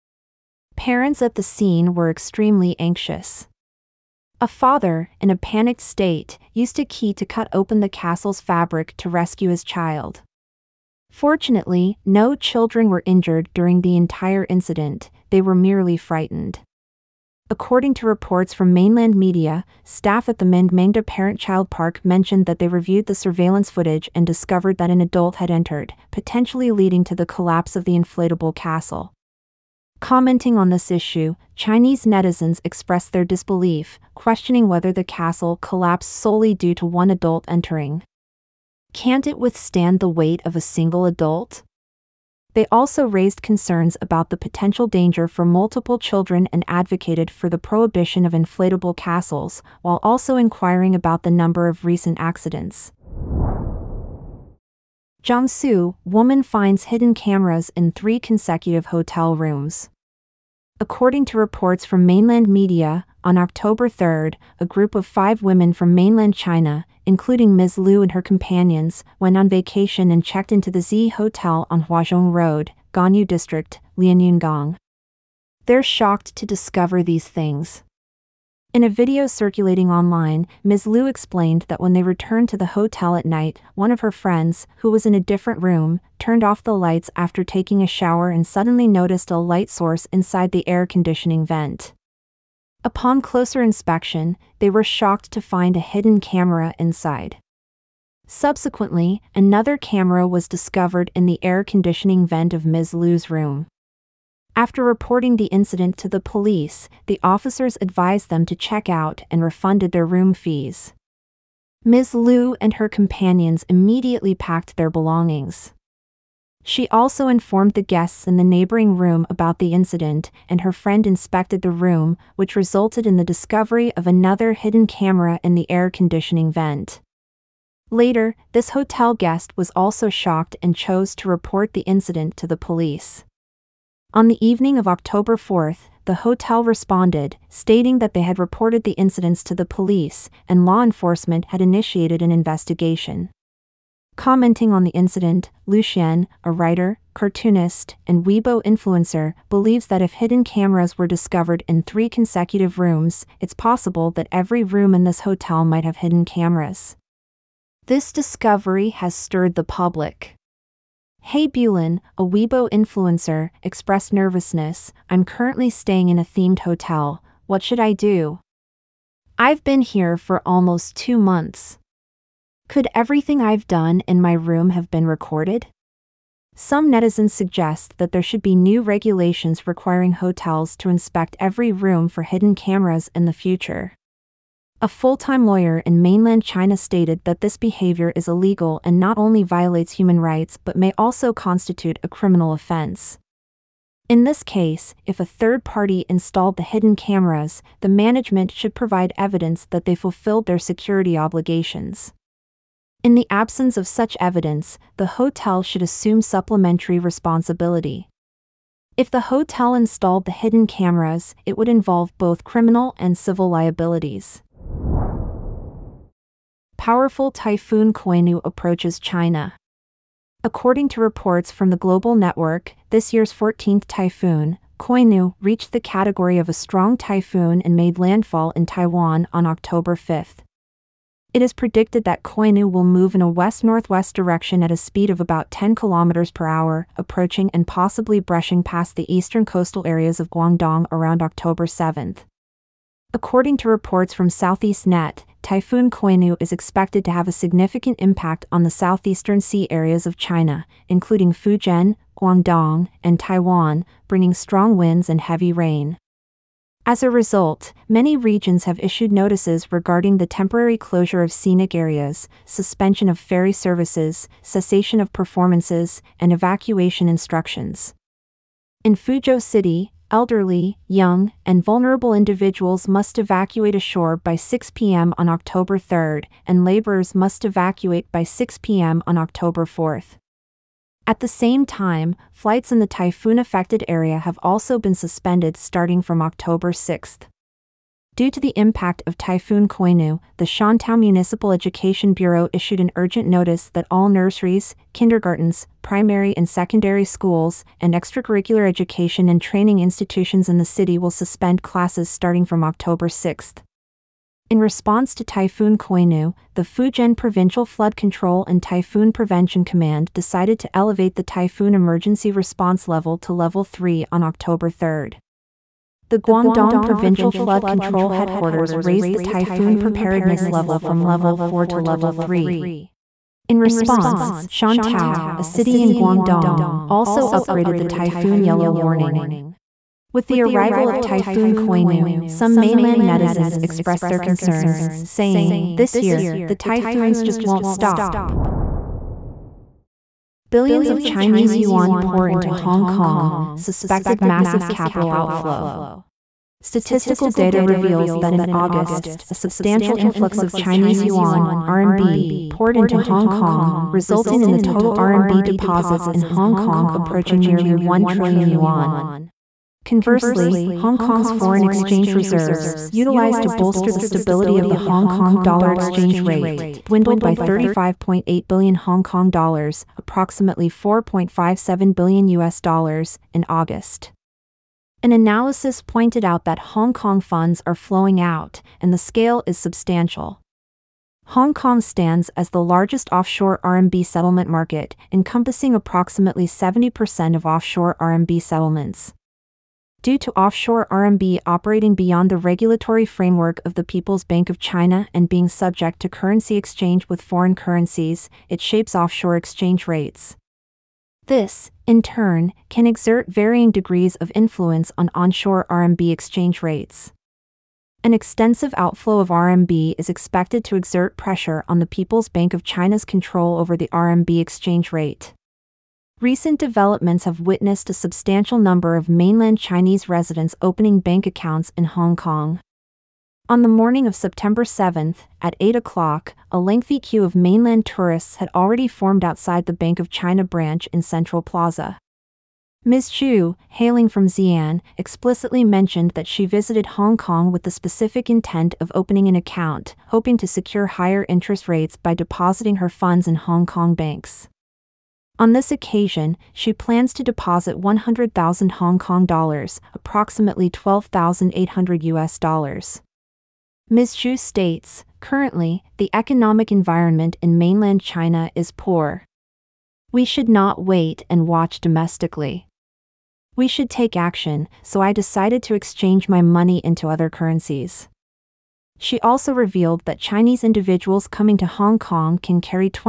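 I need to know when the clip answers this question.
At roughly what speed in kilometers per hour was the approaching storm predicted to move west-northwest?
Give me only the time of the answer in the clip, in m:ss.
3:55.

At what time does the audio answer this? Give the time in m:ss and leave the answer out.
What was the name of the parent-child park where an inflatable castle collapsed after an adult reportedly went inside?
0:20.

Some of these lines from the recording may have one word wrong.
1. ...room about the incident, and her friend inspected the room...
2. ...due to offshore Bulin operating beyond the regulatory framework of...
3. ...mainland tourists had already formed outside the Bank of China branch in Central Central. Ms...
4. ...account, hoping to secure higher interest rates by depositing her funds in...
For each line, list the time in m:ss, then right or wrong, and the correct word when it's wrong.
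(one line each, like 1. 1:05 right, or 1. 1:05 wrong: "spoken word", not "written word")
1. 1:58 right
2. 6:30 wrong: "RMB", not "Bulin"
3. 7:07 wrong: "Plaza", not "Central"
4. 7:19 right.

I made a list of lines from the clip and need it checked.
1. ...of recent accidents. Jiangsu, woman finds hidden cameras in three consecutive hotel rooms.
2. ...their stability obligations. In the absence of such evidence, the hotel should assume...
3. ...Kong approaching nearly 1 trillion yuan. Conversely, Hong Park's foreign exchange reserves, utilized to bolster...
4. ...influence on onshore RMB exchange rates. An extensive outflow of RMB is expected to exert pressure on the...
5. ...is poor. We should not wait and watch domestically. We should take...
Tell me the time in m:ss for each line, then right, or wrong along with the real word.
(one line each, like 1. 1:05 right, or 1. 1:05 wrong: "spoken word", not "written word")
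1. 0:51 right
2. 3:20 wrong: "security", not "stability"
3. 5:56 wrong: "Kong", not "Park"
4. 6:44 right
5. 7:38 right.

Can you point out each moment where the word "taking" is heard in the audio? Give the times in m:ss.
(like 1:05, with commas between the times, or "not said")
1:27.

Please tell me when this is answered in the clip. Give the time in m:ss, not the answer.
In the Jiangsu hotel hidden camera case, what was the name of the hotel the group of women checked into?
1:10.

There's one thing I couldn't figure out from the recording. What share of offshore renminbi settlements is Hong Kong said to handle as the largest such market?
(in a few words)
70%.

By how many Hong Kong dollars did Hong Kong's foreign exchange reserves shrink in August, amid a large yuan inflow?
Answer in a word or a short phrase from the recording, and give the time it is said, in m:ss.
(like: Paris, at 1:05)
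35.8 billion, at 6:07.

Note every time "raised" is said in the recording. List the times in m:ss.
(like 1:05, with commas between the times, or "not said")
0:43, 5:18.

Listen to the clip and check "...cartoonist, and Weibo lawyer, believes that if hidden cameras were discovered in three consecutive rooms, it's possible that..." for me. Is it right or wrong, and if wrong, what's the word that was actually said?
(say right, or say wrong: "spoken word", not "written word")
wrong: "influencer", not "lawyer".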